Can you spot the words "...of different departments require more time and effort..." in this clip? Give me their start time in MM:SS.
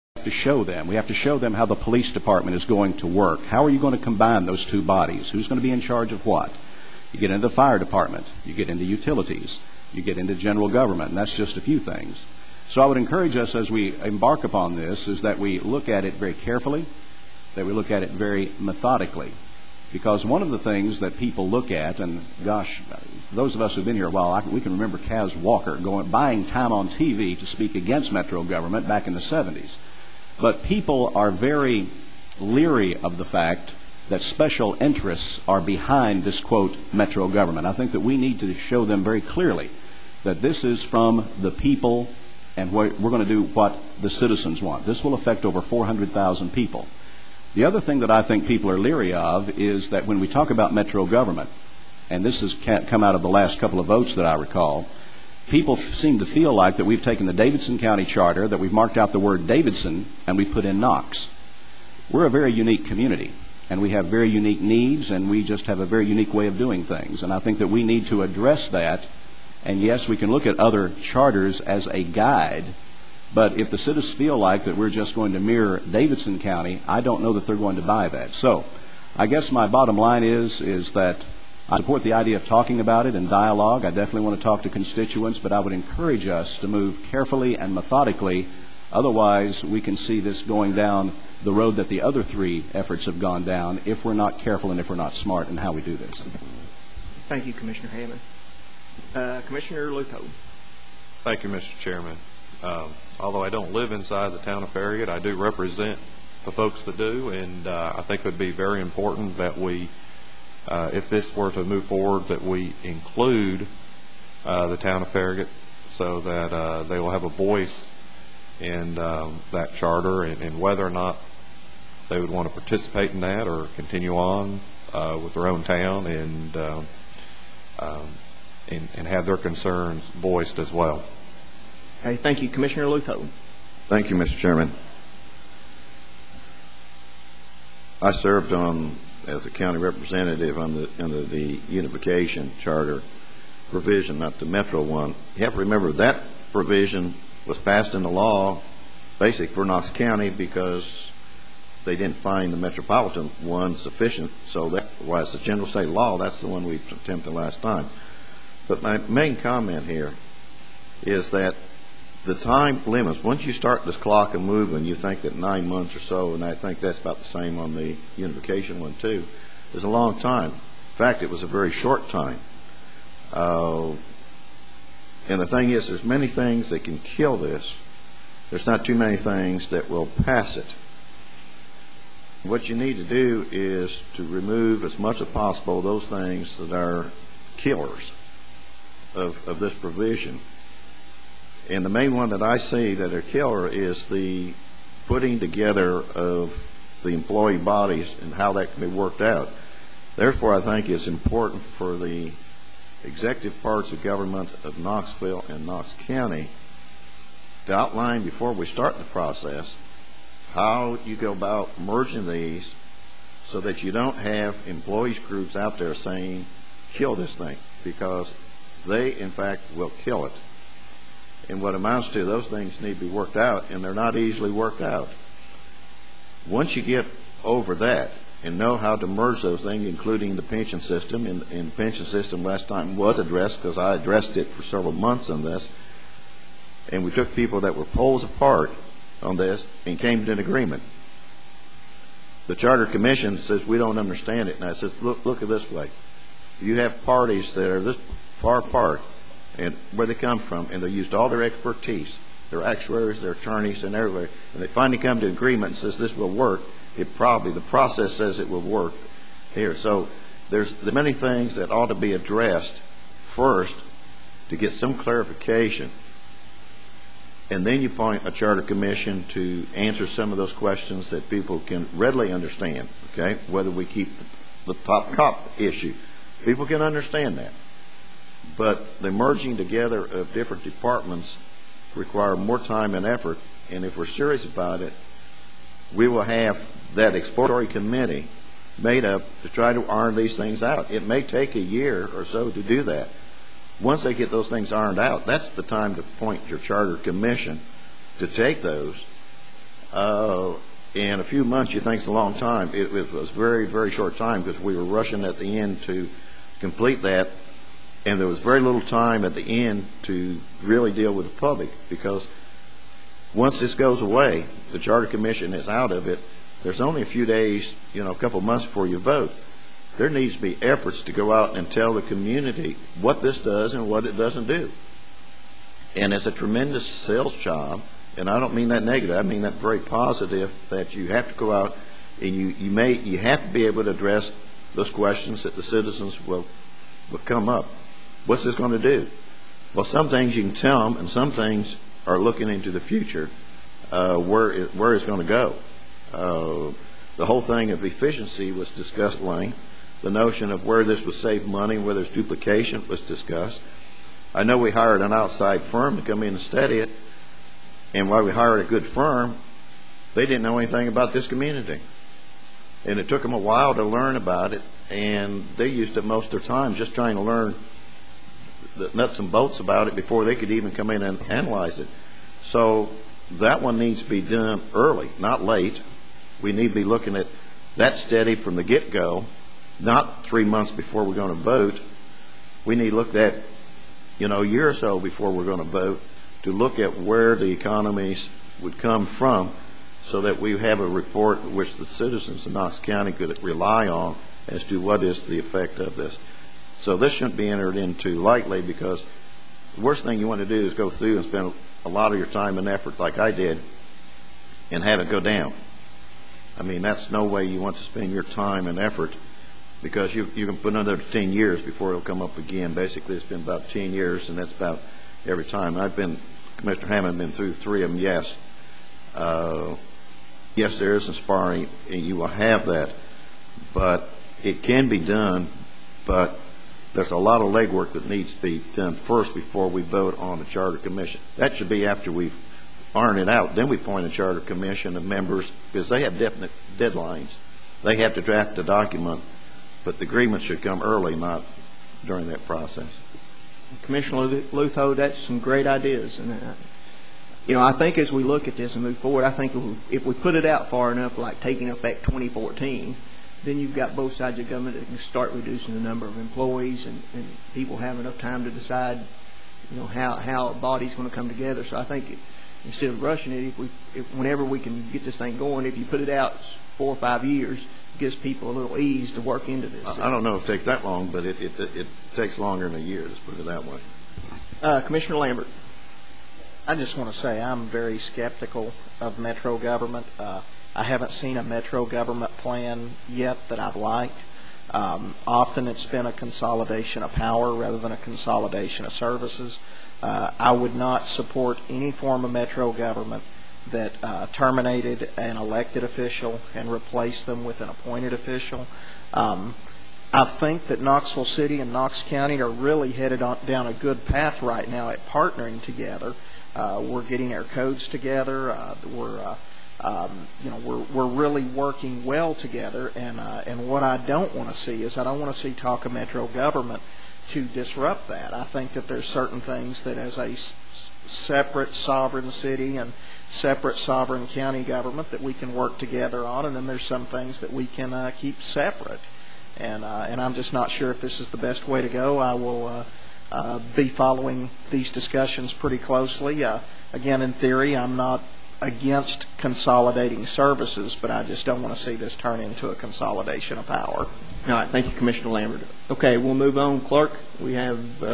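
04:39.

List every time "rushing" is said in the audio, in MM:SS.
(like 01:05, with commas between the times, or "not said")
05:04, 07:43.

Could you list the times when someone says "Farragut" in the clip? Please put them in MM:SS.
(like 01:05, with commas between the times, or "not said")
01:44, 01:55.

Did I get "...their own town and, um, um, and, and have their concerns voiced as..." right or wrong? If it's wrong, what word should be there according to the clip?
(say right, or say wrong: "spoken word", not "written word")
right.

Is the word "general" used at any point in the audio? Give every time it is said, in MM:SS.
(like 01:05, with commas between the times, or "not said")
00:10, 02:35.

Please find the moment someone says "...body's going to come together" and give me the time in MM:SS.
07:40.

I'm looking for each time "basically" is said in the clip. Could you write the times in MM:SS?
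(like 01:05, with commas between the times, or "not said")
02:29, 06:52.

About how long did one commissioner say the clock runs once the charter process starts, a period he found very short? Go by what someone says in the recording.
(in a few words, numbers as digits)
9 months.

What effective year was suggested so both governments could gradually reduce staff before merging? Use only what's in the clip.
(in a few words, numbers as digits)
2014.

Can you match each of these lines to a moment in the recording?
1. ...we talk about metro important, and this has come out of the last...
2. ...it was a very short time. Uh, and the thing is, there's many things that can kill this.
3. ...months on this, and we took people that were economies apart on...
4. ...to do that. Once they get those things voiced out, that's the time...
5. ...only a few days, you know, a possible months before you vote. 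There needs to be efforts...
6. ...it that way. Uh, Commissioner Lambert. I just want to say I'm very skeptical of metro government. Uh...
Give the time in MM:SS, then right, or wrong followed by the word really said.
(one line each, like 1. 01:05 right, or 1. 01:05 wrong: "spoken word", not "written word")
1. 00:50 wrong: "government", not "important"
2. 02:51 right
3. 03:54 wrong: "poles", not "economies"
4. 04:52 wrong: "ironed", not "voiced"
5. 05:16 wrong: "couple", not "possible"
6. 07:53 right.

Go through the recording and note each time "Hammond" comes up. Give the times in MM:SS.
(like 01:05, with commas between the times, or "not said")
01:37, 06:56.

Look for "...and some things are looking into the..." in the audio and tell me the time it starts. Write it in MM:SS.
05:40.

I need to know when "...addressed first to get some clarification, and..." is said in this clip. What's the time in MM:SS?
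04:22.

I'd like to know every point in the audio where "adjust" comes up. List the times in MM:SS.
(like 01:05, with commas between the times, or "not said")
not said.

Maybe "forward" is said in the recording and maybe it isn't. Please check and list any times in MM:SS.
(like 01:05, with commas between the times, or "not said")
01:51, 07:28.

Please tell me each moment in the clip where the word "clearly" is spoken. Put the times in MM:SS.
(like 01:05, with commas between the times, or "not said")
00:39.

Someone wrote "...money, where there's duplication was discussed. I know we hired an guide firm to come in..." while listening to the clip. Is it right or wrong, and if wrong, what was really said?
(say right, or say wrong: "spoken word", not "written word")
wrong: "outside", not "guide".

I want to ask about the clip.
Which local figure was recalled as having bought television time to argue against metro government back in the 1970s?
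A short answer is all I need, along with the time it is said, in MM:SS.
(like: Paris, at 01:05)
Cas Walker, at 00:24.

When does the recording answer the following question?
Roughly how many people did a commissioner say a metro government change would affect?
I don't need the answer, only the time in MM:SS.
00:45.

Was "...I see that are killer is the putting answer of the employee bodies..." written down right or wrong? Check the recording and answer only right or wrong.
wrong.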